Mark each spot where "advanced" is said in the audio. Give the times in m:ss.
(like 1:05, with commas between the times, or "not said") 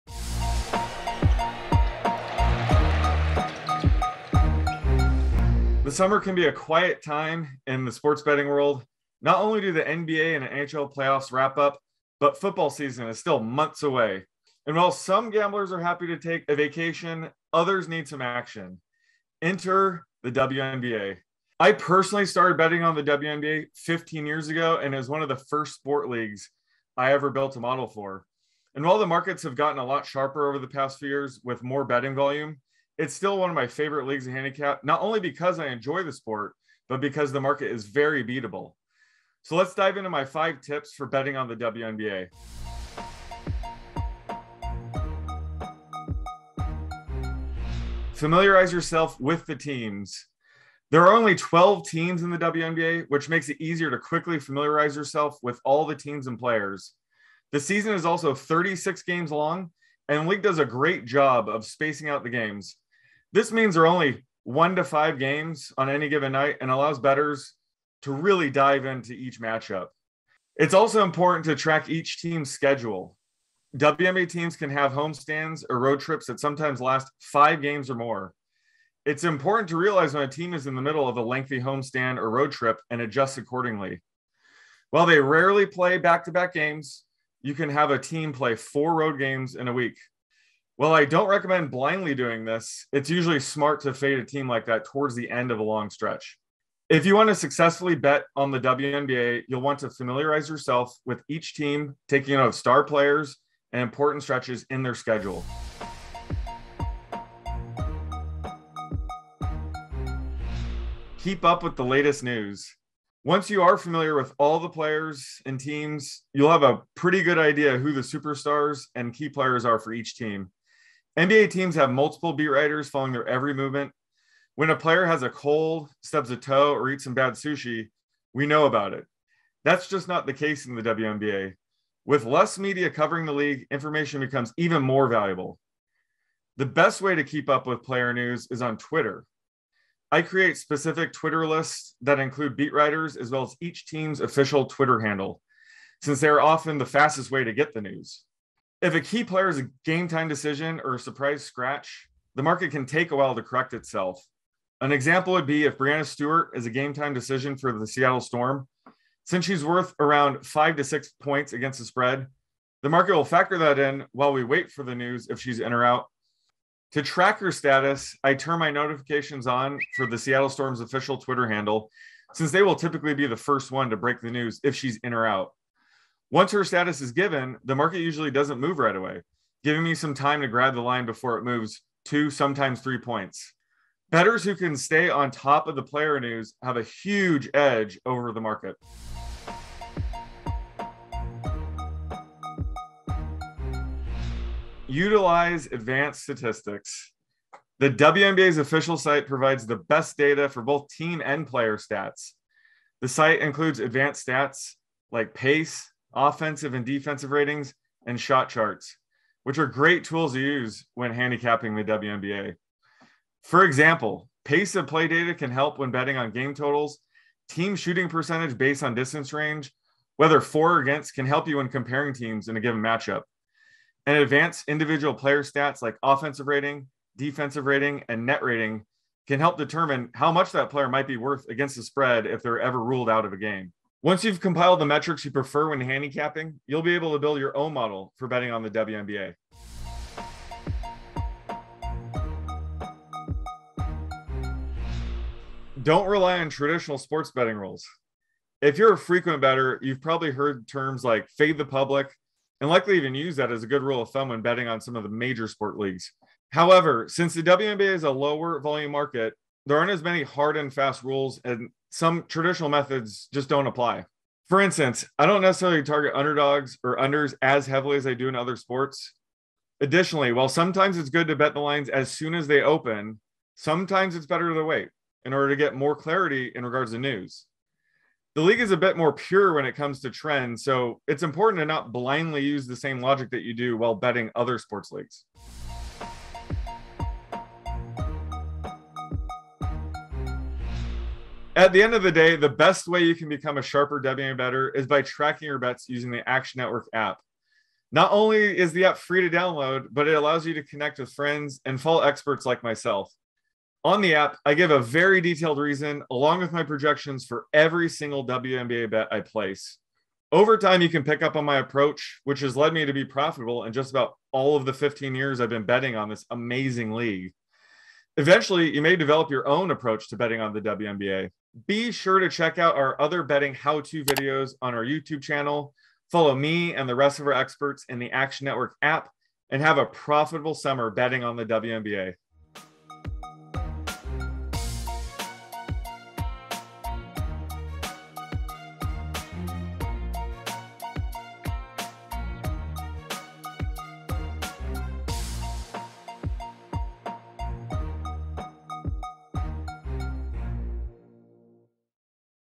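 3:15, 3:23, 3:44.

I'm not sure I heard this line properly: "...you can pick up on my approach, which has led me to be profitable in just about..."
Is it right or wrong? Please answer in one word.
right.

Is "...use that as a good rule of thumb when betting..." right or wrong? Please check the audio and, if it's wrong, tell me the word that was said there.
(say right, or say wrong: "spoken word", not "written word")
right.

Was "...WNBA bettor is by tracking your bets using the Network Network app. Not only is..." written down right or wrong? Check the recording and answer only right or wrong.
wrong.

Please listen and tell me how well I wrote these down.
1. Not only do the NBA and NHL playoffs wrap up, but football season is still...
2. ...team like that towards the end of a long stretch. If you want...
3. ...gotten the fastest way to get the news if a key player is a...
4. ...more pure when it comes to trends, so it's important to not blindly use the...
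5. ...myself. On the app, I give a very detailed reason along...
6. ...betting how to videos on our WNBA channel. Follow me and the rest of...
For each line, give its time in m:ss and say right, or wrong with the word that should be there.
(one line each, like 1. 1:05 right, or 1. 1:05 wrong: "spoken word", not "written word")
1. 0:09 right
2. 1:34 right
3. 2:26 wrong: "often", not "gotten"
4. 4:38 right
5. 5:02 right
6. 5:23 wrong: "YouTube", not "WNBA".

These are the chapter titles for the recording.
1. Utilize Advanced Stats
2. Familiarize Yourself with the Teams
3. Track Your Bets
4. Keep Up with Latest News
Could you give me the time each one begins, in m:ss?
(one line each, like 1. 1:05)
1. 3:09
2. 0:43
3. 4:46
4. 1:46.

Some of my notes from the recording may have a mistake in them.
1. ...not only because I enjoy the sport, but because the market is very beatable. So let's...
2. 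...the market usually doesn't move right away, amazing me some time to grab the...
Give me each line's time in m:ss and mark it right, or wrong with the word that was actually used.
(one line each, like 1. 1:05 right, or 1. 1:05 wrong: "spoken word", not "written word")
1. 0:34 right
2. 2:57 wrong: "giving", not "amazing".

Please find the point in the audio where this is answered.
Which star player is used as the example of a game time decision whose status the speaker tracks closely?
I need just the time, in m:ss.
2:35.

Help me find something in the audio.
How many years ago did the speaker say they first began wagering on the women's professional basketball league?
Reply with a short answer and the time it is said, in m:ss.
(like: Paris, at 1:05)
15, at 0:23.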